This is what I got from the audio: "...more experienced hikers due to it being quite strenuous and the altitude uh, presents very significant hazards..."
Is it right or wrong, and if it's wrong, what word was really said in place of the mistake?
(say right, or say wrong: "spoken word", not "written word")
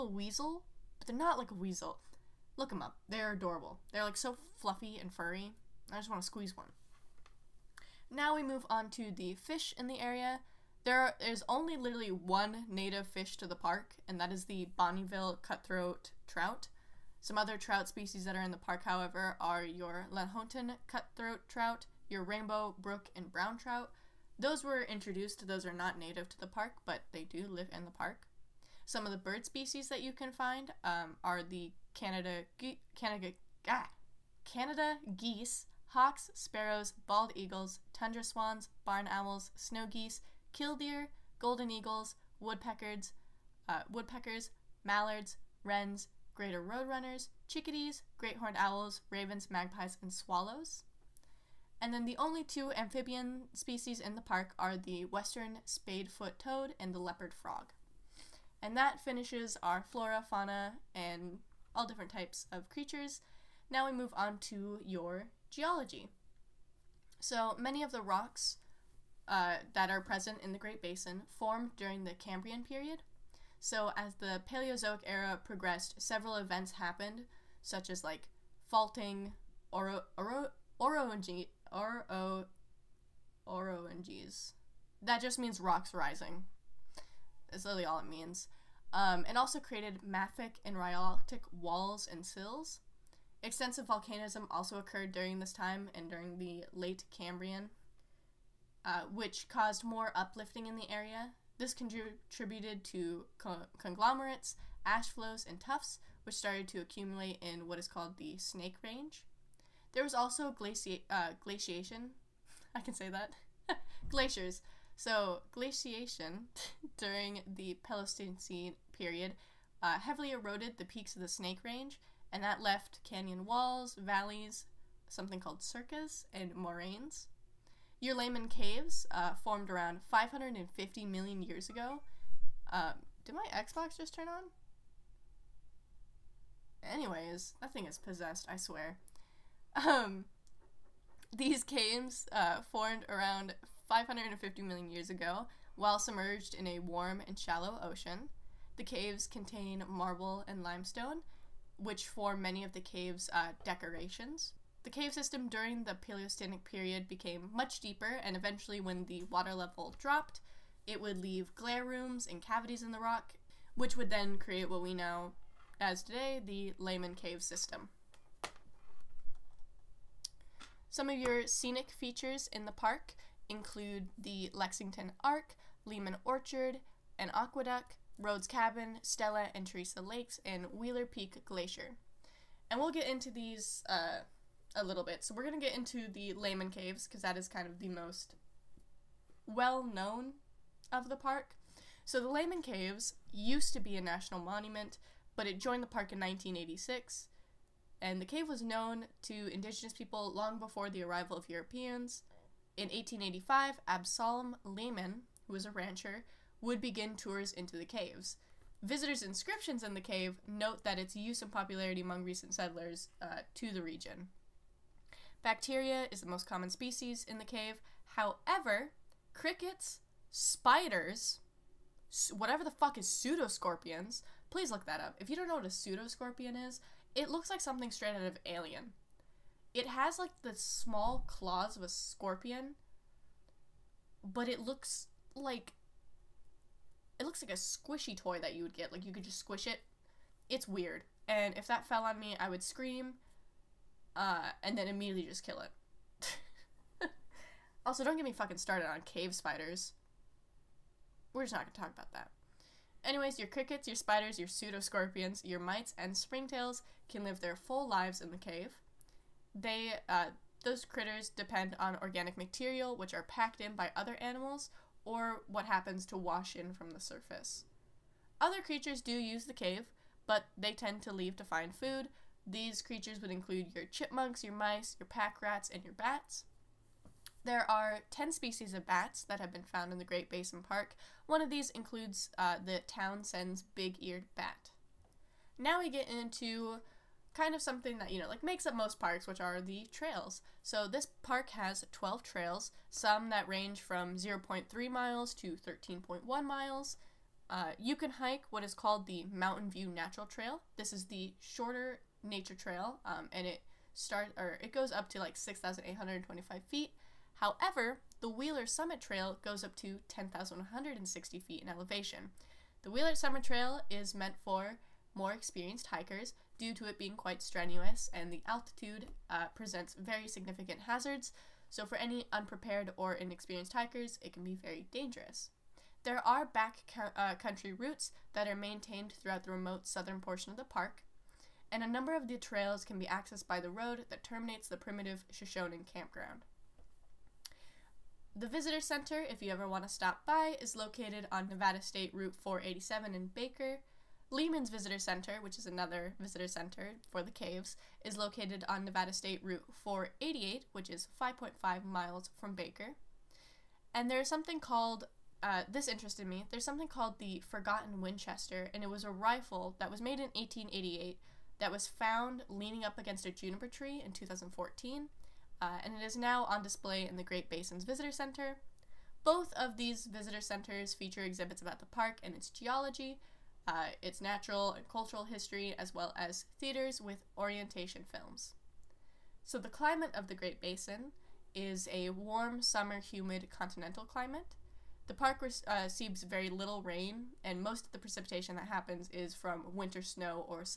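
right.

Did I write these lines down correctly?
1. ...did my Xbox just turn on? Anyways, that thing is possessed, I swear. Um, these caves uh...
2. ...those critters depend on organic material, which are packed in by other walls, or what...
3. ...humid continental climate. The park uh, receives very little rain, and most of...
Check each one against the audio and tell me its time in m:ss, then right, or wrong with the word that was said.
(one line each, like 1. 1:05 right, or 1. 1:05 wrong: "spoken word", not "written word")
1. 2:13 right
2. 4:20 wrong: "animals", not "walls"
3. 6:22 right.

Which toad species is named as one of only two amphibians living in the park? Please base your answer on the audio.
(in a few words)
western spadefoot toad.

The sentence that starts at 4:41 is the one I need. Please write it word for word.
One of these includes uh, the Townsend's big eared bat.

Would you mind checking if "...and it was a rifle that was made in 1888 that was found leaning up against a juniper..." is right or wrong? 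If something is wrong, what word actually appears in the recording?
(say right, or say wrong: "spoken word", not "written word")
right.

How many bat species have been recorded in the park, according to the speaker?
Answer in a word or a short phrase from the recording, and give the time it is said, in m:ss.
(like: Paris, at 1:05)
10, at 4:38.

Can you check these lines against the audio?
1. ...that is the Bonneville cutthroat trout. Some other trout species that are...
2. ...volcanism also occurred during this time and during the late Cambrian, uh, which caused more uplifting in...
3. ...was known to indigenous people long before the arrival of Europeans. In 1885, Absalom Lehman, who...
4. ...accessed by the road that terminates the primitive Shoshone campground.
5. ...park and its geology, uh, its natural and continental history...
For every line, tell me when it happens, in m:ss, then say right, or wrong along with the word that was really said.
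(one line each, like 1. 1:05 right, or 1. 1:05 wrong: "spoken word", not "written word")
1. 0:14 right
2. 1:33 right
3. 3:18 right
4. 5:33 right
5. 6:11 wrong: "cultural", not "continental".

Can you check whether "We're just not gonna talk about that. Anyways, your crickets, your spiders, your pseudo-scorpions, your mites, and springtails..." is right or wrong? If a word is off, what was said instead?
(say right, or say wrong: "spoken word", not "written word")
right.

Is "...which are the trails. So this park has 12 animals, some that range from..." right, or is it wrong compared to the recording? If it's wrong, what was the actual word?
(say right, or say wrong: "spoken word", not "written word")
wrong: "trails", not "animals".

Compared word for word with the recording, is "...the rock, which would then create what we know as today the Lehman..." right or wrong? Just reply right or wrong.
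right.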